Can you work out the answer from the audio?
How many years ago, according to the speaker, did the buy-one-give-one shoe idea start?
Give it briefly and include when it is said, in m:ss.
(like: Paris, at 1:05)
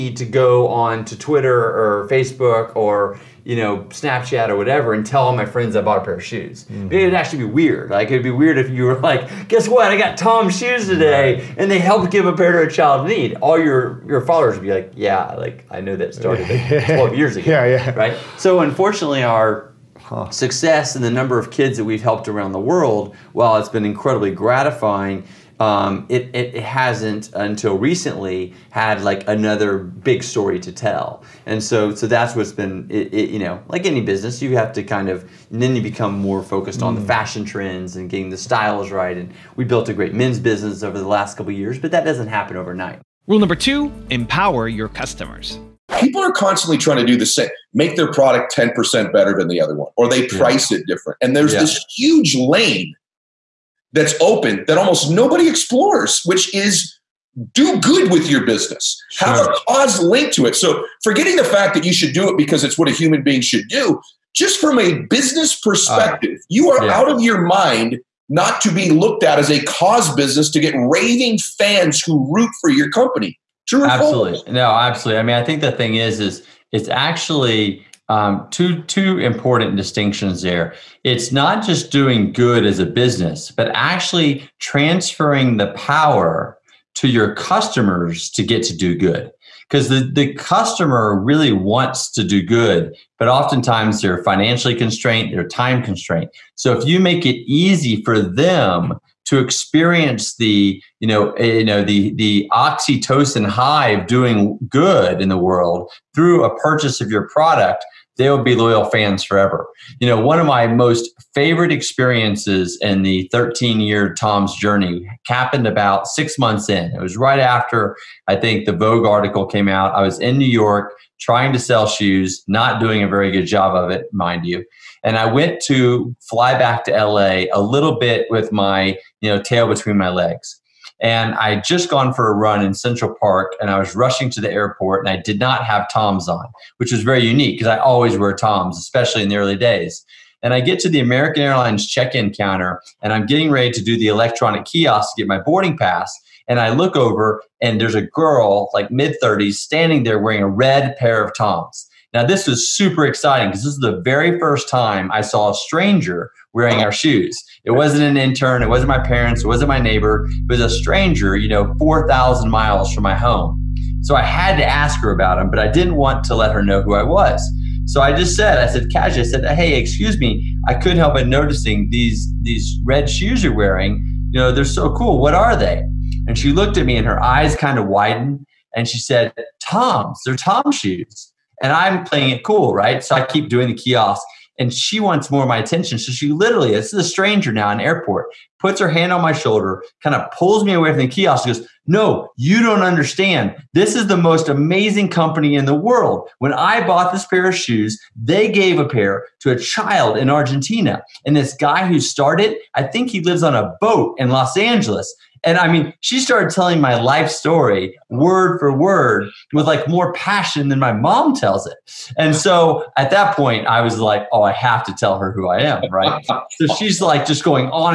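12 years, at 0:16.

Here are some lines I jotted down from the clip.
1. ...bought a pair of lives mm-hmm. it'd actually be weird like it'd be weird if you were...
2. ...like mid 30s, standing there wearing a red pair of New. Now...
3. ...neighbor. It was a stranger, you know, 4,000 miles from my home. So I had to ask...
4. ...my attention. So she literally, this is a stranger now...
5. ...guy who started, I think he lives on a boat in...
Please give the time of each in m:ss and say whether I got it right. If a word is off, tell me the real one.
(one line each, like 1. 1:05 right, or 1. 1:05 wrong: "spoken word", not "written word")
1. 0:05 wrong: "shoes", not "lives"
2. 2:28 wrong: "Toms", not "New"
3. 2:39 right
4. 3:05 right
5. 3:21 right.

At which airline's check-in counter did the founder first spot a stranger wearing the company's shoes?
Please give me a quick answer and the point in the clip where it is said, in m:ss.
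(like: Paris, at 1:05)
American Airlines, at 2:21.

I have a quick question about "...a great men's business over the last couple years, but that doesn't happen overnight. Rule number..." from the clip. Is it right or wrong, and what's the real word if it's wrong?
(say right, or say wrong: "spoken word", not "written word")
right.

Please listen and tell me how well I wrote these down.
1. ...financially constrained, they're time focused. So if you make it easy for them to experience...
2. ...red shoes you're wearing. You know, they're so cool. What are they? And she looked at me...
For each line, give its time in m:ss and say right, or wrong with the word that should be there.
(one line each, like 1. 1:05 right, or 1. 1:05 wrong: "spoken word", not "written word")
1. 1:34 wrong: "constrained", not "focused"
2. 2:52 right.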